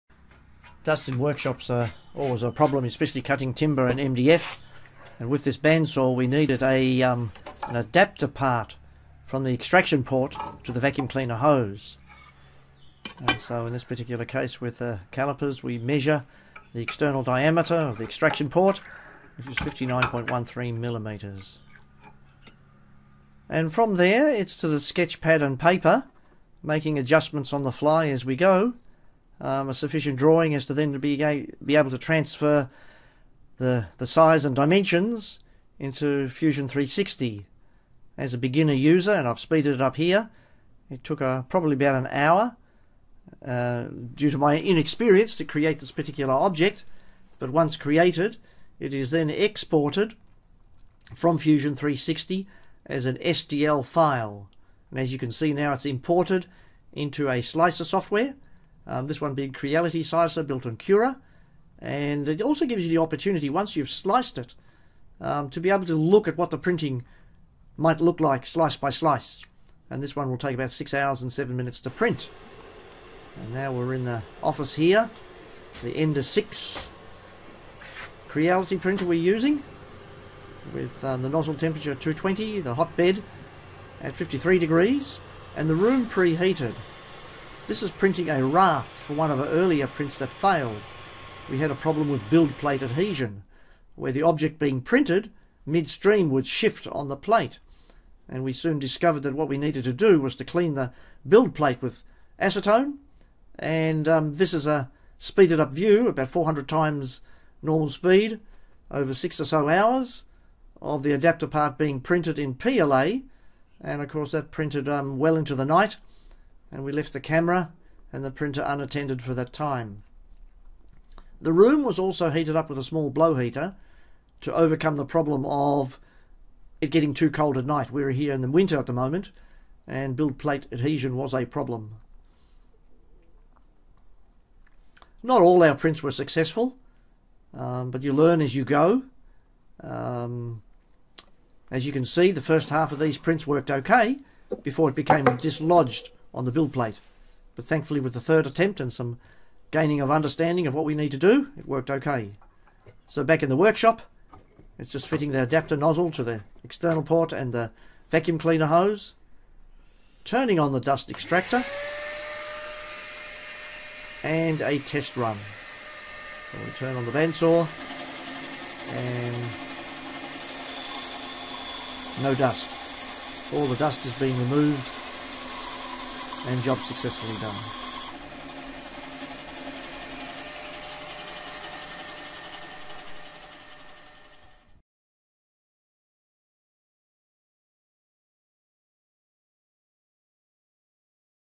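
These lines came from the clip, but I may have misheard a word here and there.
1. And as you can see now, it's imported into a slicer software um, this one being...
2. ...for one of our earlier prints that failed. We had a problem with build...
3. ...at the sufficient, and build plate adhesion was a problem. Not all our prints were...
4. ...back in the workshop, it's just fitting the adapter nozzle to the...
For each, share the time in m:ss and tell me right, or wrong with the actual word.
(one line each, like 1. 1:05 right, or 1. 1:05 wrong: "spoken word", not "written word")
1. 0:54 right
2. 1:28 right
3. 2:08 wrong: "moment", not "sufficient"
4. 2:33 right.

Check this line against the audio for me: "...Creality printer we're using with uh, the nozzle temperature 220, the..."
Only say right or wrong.
right.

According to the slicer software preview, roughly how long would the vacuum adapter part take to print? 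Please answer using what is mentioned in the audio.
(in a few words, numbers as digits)
6 hours and 7 minutes.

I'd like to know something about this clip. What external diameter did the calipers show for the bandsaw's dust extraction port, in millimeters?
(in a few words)
59.13.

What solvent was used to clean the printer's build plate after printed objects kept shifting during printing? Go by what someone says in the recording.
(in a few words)
acetone.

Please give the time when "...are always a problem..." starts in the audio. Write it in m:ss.
0:01.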